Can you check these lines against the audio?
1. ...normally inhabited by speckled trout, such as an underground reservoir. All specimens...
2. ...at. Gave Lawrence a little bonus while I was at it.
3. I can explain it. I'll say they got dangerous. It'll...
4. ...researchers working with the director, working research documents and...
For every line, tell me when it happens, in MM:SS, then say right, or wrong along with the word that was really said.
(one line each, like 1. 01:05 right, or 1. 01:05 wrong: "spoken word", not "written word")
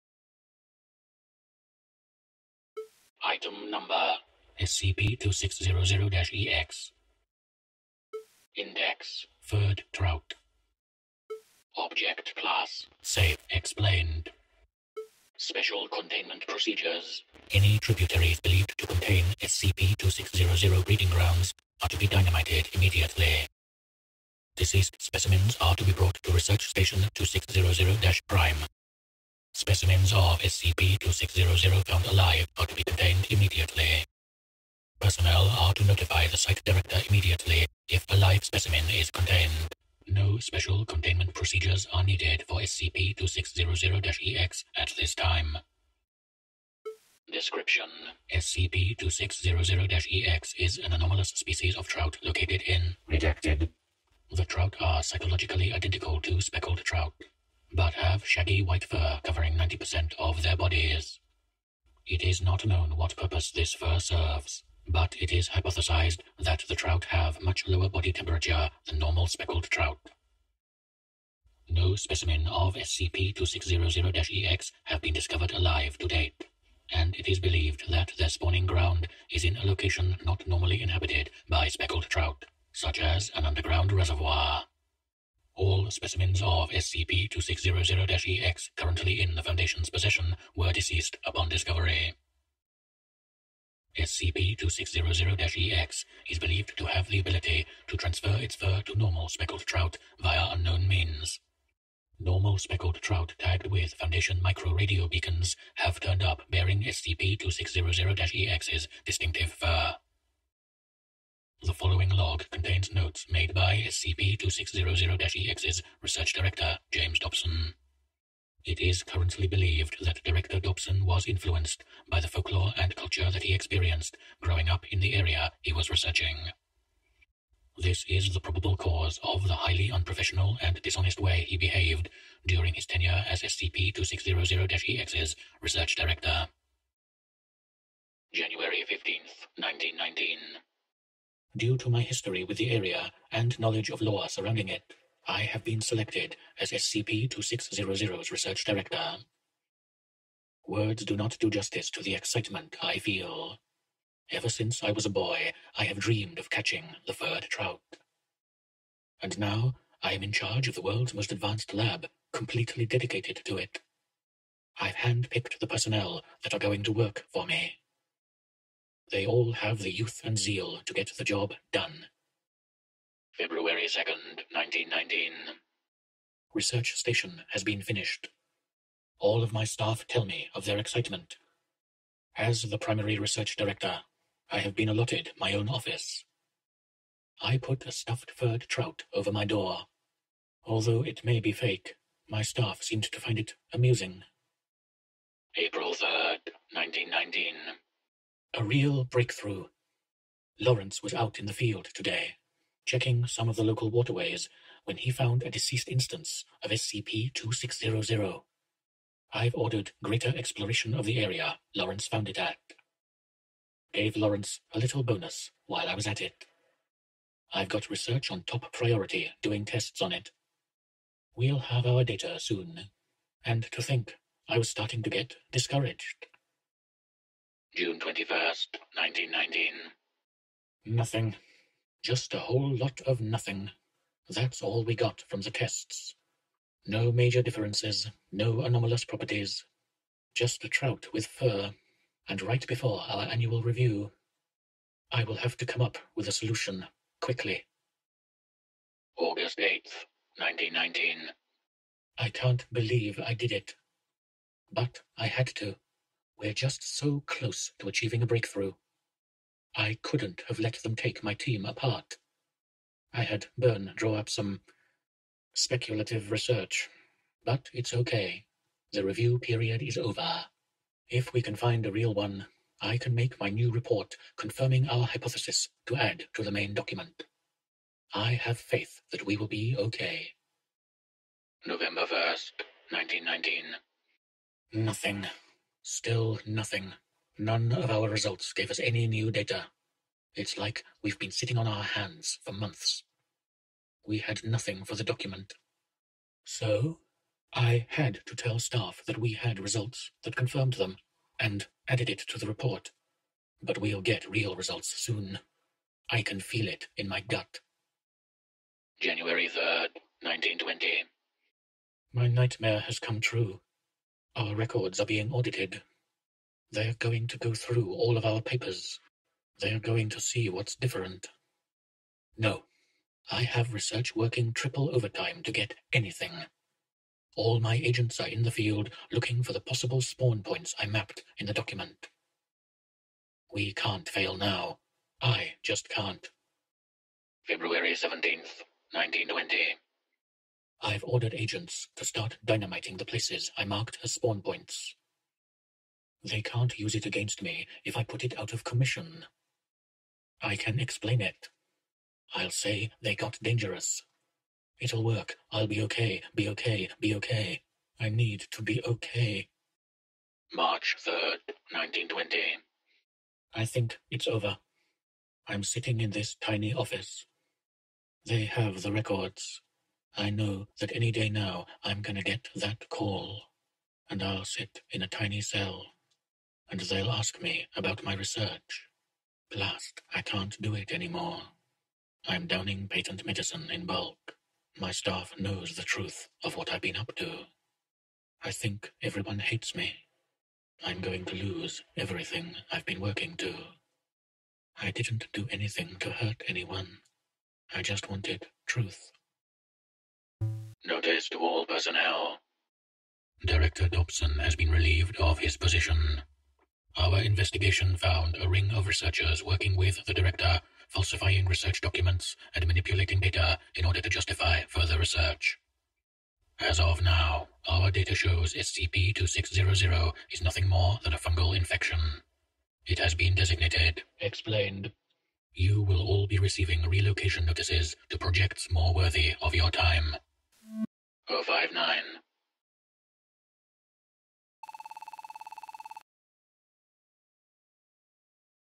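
1. 01:20 right
2. 03:32 right
3. 05:50 right
4. 06:48 wrong: "falsifying", not "working".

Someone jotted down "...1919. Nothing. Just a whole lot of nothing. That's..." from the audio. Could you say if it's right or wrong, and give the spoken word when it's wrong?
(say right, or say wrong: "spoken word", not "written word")
right.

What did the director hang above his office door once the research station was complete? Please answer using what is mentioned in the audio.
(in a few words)
A stuffed furred trout.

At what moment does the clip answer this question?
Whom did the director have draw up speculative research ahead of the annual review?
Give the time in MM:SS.
04:23.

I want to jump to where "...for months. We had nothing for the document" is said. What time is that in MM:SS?
04:52.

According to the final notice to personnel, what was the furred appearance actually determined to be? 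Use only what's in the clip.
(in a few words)
A fungal infection.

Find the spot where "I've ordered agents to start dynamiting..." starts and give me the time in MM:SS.
05:40.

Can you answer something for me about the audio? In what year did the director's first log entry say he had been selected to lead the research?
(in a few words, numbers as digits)
1919.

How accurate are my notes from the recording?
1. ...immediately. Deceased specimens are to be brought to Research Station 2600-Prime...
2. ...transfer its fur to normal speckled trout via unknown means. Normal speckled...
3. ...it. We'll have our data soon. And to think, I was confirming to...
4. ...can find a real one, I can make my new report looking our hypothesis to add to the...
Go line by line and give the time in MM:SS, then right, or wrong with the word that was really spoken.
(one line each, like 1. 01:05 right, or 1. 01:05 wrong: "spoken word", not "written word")
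1. 00:22 right
2. 01:37 right
3. 03:40 wrong: "starting", not "confirming"
4. 04:31 wrong: "confirming", not "looking".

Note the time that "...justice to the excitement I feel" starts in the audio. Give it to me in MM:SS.
02:31.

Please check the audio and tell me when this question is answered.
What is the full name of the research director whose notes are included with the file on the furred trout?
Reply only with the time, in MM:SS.
01:56.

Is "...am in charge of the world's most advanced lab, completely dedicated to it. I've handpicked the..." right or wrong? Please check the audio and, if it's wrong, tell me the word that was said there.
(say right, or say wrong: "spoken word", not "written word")
right.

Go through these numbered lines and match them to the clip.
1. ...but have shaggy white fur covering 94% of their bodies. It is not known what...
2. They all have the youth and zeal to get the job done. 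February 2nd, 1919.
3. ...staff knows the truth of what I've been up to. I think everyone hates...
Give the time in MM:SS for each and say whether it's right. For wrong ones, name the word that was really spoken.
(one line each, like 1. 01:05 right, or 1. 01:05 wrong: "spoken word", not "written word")
1. 00:57 wrong: "90", not "94"
2. 02:49 right
3. 06:24 right.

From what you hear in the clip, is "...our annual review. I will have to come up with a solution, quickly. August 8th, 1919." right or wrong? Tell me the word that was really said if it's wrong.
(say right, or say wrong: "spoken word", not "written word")
right.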